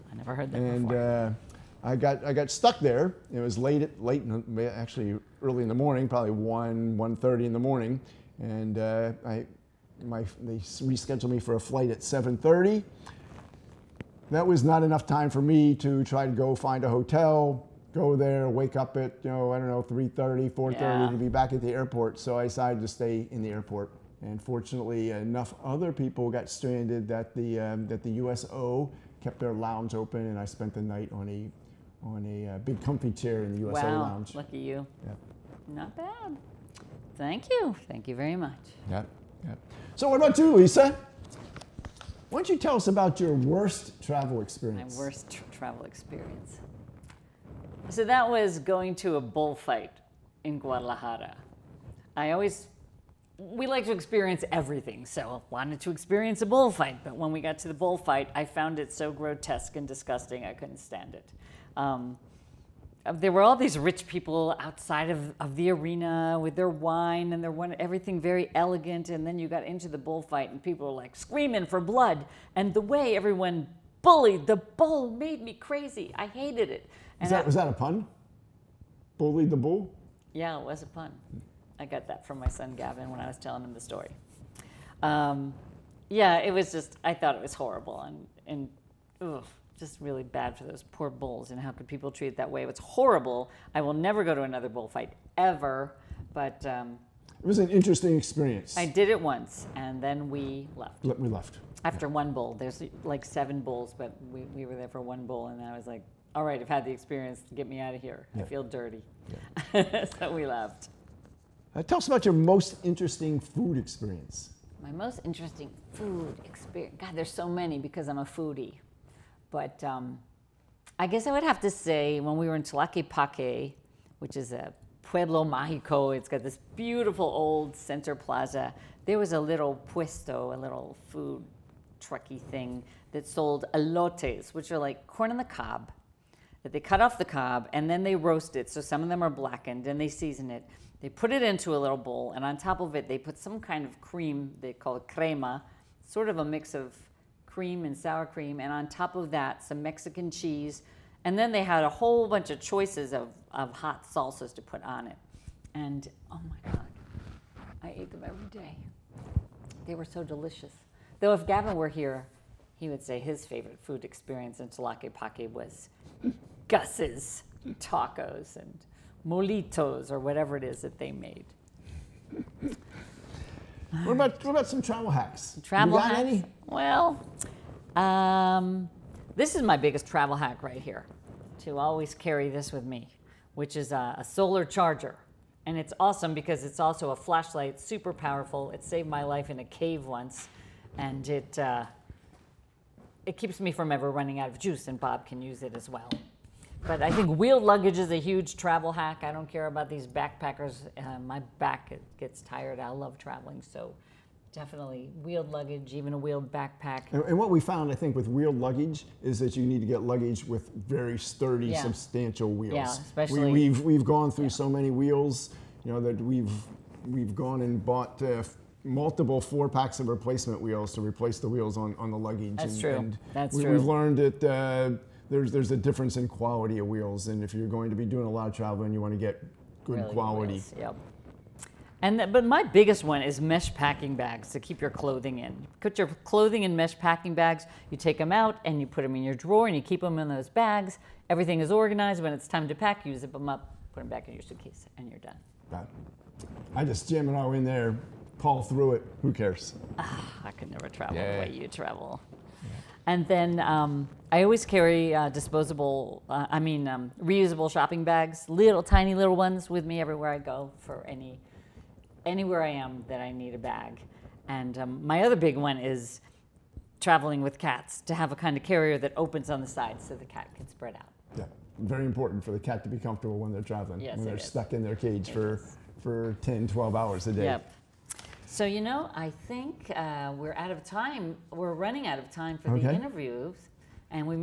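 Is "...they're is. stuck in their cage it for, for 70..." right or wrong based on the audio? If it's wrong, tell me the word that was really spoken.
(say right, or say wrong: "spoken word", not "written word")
wrong: "10", not "70".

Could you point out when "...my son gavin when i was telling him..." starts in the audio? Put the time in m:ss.
1:22.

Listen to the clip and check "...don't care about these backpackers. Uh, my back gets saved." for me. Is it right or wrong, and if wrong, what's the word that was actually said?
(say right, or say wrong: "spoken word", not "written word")
wrong: "tired", not "saved".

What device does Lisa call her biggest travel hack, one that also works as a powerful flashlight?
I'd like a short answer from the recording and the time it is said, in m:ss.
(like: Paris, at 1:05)
Solar charger, at 3:04.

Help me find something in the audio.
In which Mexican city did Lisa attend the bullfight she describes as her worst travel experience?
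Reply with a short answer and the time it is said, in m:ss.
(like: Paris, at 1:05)
Guadalajara, at 0:50.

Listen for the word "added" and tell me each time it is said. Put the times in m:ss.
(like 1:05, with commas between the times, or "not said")
not said.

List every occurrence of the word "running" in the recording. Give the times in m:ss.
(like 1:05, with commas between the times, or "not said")
3:14, 4:41.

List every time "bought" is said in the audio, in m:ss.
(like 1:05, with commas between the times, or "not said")
3:37.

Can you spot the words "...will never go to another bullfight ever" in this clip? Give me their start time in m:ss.
1:33.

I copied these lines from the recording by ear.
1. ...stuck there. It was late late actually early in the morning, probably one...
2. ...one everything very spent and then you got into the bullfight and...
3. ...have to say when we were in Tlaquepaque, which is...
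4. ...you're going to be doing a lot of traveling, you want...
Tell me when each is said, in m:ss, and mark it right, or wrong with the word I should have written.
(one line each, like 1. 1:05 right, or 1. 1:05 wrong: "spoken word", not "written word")
1. 0:02 right
2. 1:07 wrong: "elegant", not "spent"
3. 2:01 right
4. 3:47 right.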